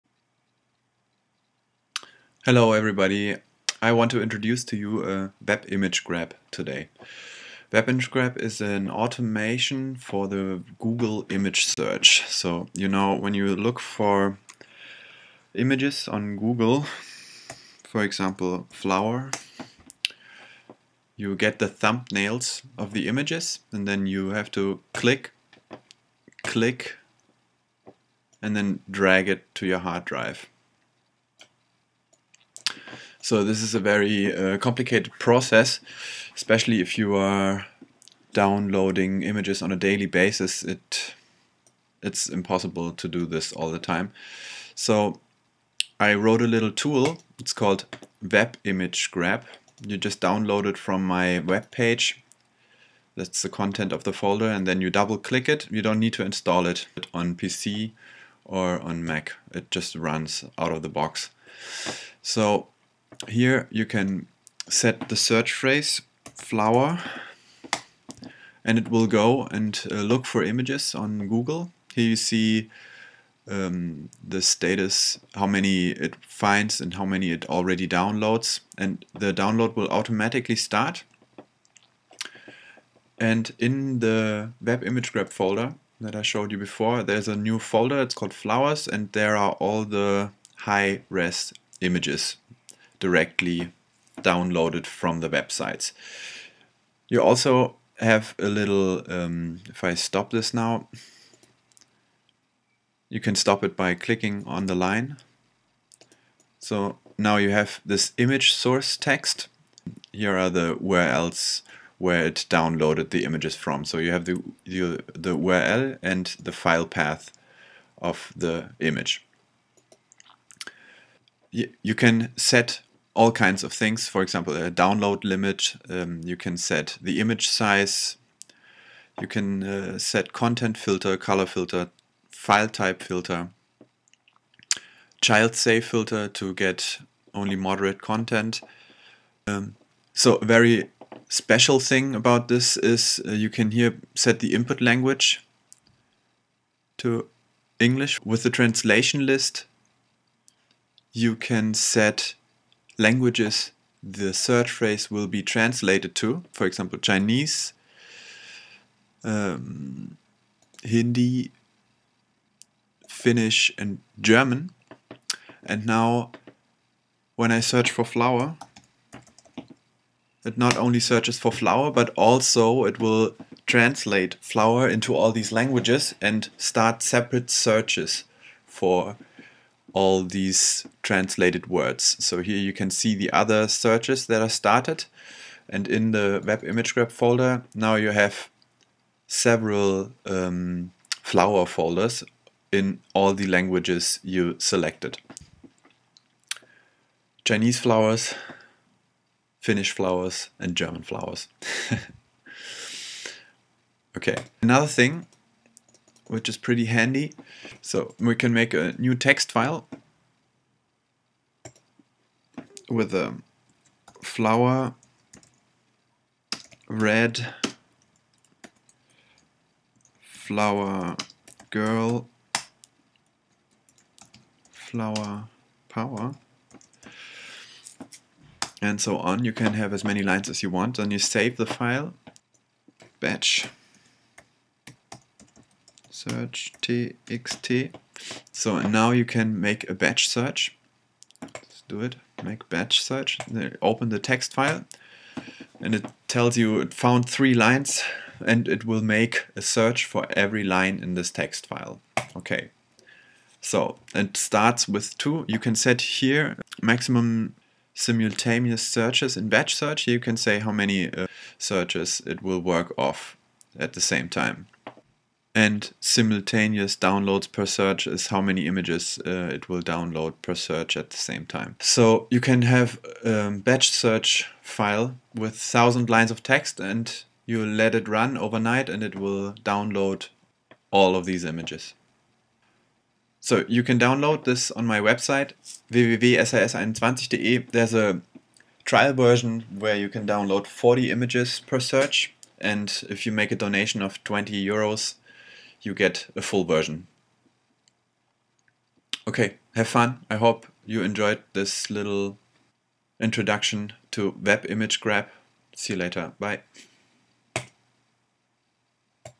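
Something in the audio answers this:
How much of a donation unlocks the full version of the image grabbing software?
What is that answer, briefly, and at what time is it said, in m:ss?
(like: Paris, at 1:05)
20 euros, at 4:54.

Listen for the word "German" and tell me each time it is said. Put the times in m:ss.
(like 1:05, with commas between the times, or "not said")
2:44, 3:20.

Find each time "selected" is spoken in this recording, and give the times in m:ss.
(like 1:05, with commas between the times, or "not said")
3:14.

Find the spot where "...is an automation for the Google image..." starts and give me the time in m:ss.
0:08.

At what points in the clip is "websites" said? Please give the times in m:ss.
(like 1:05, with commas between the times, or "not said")
1:35, 4:45.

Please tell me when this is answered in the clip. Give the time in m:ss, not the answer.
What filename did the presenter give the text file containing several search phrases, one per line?
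3:53.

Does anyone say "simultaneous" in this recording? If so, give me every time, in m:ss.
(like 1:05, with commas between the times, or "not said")
4:17, 4:25.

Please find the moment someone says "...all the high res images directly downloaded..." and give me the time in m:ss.
1:29.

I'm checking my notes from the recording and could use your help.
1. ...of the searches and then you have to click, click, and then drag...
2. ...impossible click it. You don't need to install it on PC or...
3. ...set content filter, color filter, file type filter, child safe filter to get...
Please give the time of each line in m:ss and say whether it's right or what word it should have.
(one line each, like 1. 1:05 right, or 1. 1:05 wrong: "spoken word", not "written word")
1. 0:22 wrong: "images", not "searches"
2. 0:54 wrong: "double", not "impossible"
3. 2:09 right.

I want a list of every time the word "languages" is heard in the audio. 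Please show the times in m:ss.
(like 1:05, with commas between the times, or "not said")
2:24, 2:33, 2:55, 3:13.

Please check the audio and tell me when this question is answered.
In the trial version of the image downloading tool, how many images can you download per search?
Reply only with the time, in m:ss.
4:50.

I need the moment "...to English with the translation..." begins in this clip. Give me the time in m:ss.
2:26.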